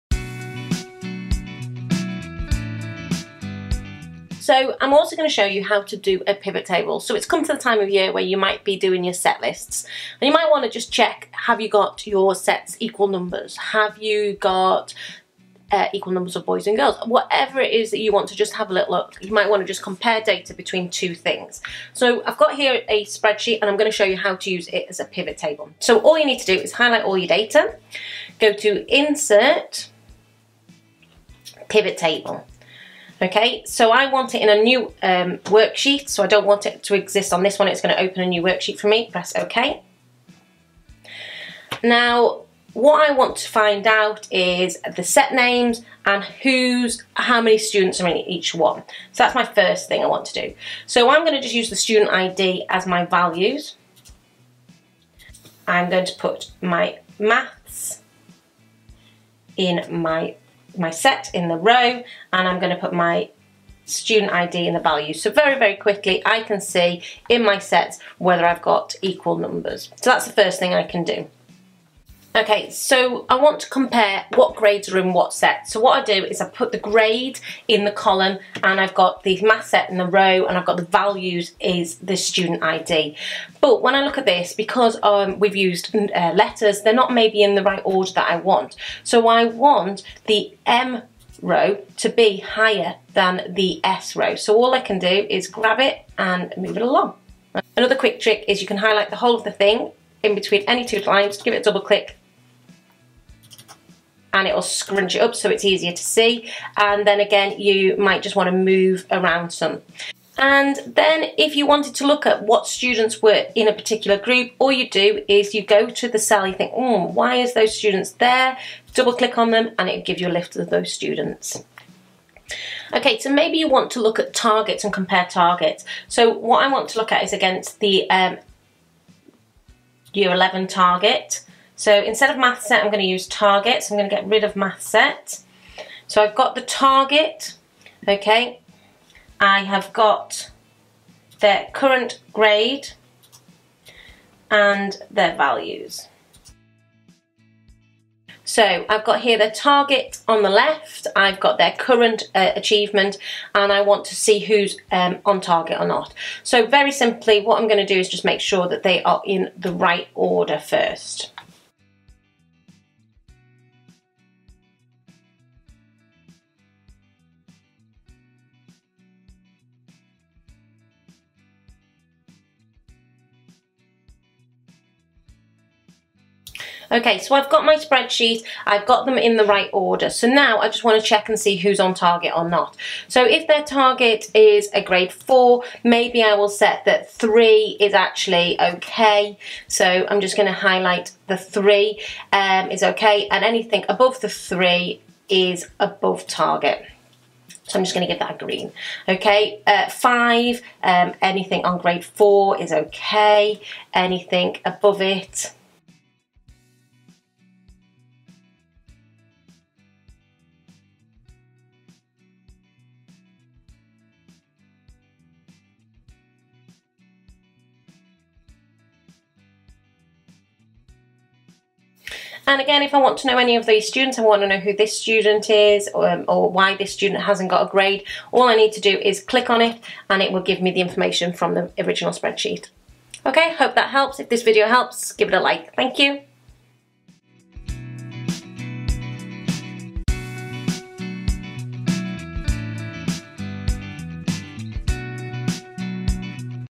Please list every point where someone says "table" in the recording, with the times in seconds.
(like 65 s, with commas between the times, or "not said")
6 s, 25 s, 31 s.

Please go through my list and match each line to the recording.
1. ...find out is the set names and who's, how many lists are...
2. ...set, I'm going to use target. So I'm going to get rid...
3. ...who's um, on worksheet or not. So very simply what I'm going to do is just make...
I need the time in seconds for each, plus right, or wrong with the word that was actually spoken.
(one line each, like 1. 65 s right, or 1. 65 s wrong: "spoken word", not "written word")
1. 43 s wrong: "students", not "lists"
2. 132 s right
3. 154 s wrong: "target", not "worksheet".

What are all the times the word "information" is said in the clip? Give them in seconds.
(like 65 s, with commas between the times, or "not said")
230 s.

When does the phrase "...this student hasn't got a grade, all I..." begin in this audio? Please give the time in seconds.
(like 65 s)
226 s.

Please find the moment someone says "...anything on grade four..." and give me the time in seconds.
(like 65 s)
201 s.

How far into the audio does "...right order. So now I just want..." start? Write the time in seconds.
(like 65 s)
179 s.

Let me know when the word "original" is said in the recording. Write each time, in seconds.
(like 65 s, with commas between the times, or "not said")
231 s.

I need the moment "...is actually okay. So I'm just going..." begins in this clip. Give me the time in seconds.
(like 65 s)
187 s.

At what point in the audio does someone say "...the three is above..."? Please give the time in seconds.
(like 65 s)
194 s.